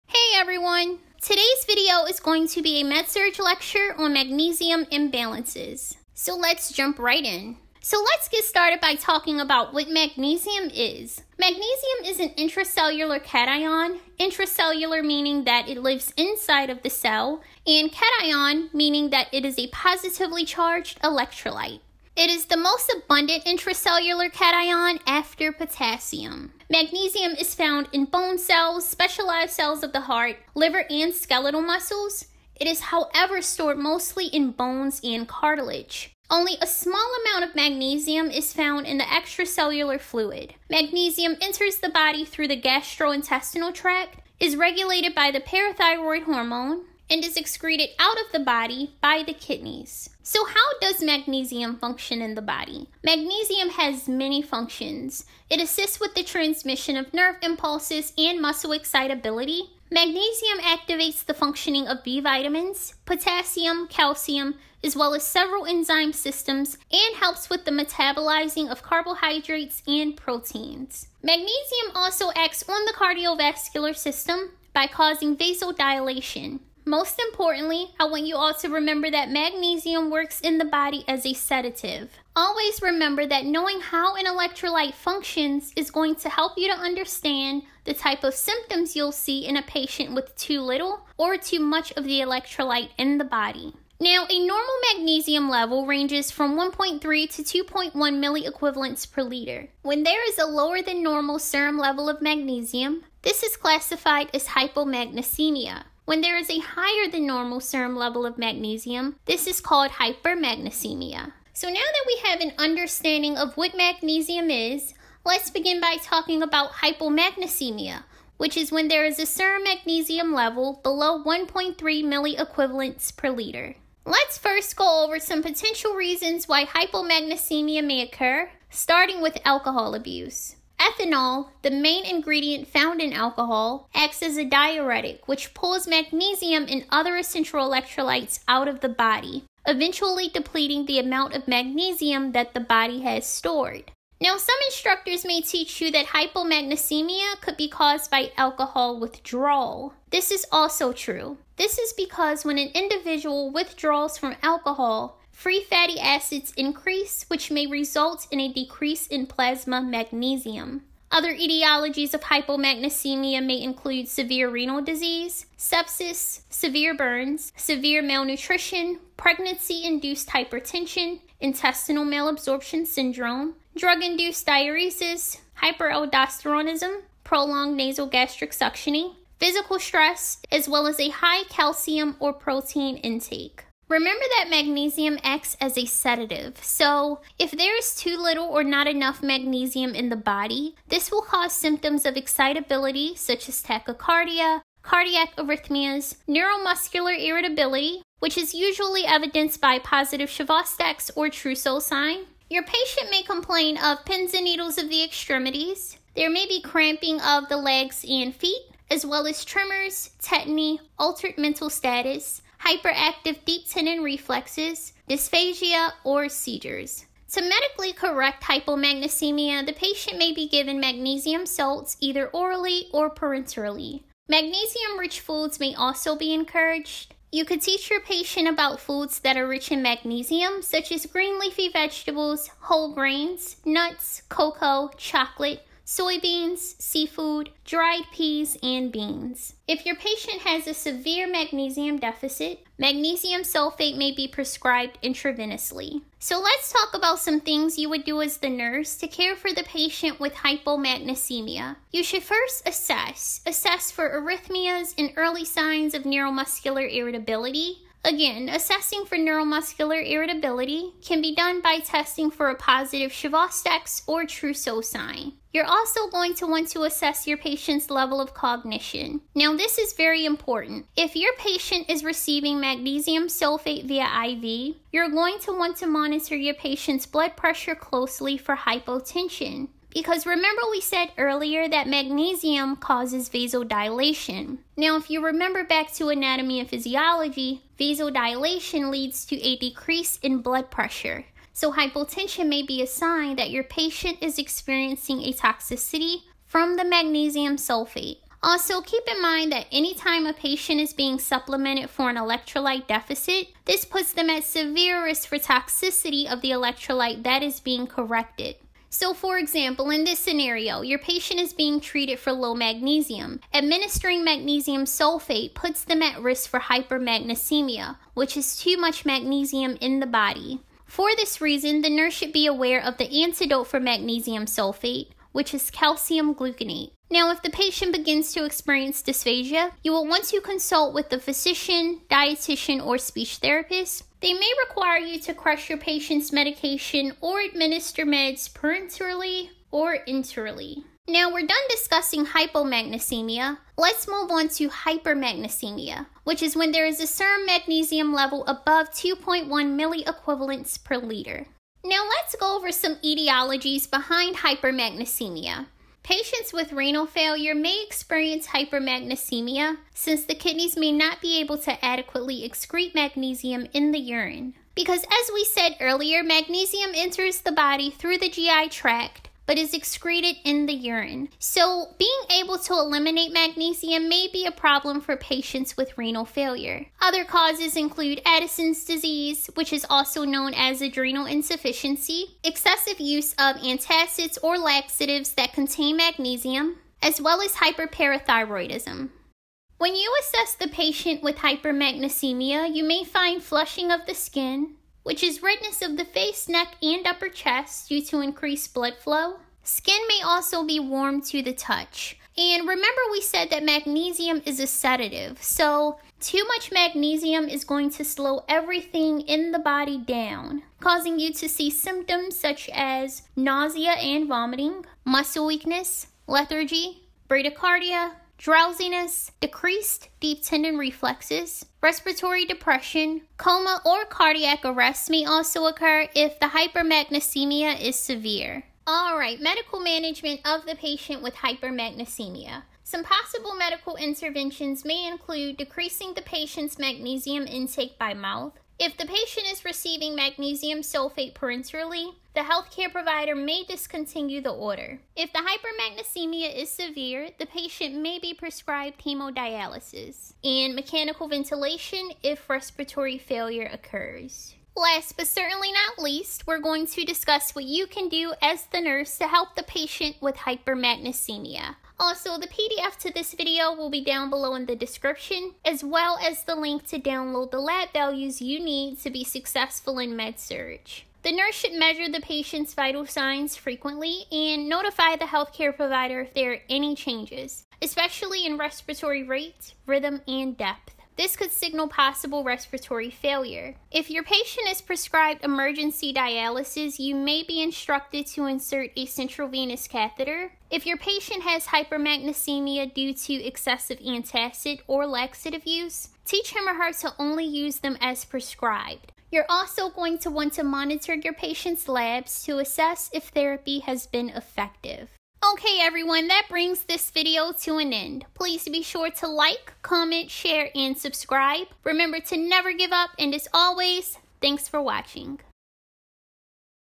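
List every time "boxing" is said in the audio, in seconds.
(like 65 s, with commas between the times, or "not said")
not said.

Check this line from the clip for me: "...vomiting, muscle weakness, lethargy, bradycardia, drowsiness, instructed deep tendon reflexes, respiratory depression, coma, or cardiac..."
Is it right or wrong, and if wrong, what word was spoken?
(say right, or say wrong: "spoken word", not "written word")
wrong: "decreased", not "instructed".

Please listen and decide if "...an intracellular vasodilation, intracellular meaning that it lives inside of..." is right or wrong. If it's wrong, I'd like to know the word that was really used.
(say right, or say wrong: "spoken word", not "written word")
wrong: "cation", not "vasodilation".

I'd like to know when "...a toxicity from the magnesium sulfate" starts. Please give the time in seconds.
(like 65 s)
295 s.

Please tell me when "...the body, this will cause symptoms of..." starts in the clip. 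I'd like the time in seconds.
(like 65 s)
190 s.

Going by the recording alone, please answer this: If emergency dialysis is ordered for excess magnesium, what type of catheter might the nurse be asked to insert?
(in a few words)
Central venous catheter.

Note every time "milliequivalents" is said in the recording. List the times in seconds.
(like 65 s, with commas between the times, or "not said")
97 s, 121 s, 349 s.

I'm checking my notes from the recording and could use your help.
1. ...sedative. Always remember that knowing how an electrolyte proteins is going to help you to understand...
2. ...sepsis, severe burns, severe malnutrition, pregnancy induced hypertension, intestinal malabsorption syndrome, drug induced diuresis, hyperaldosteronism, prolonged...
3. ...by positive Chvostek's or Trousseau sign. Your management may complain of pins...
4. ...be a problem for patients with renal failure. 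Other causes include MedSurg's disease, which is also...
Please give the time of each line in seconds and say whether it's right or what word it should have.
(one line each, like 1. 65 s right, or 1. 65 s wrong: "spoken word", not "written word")
1. 81 s wrong: "functions", not "proteins"
2. 165 s right
3. 199 s wrong: "patient", not "management"
4. 374 s wrong: "Addison", not "MedSurg".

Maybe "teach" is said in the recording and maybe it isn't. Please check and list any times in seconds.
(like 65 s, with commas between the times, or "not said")
145 s, 227 s, 496 s.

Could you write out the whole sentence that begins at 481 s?
This could signal possible respiratory failure.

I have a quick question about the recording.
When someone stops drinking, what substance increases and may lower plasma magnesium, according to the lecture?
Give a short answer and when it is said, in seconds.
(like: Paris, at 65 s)
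Free fatty acids, at 155 s.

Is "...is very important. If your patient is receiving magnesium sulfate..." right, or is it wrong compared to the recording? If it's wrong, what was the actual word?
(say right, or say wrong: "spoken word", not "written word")
right.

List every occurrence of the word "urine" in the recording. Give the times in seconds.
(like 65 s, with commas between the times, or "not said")
363 s, 370 s.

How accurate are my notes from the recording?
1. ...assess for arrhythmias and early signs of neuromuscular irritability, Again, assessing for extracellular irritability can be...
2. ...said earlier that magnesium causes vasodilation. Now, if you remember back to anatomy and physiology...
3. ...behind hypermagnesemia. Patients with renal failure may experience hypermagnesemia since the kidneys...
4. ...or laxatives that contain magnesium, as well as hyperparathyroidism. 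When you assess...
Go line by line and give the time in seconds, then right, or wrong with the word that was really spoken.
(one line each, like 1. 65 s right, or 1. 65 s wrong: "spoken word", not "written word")
1. 253 s wrong: "neuromuscular", not "extracellular"
2. 280 s right
3. 353 s right
4. 384 s right.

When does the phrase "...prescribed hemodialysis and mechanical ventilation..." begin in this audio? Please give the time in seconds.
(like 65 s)
448 s.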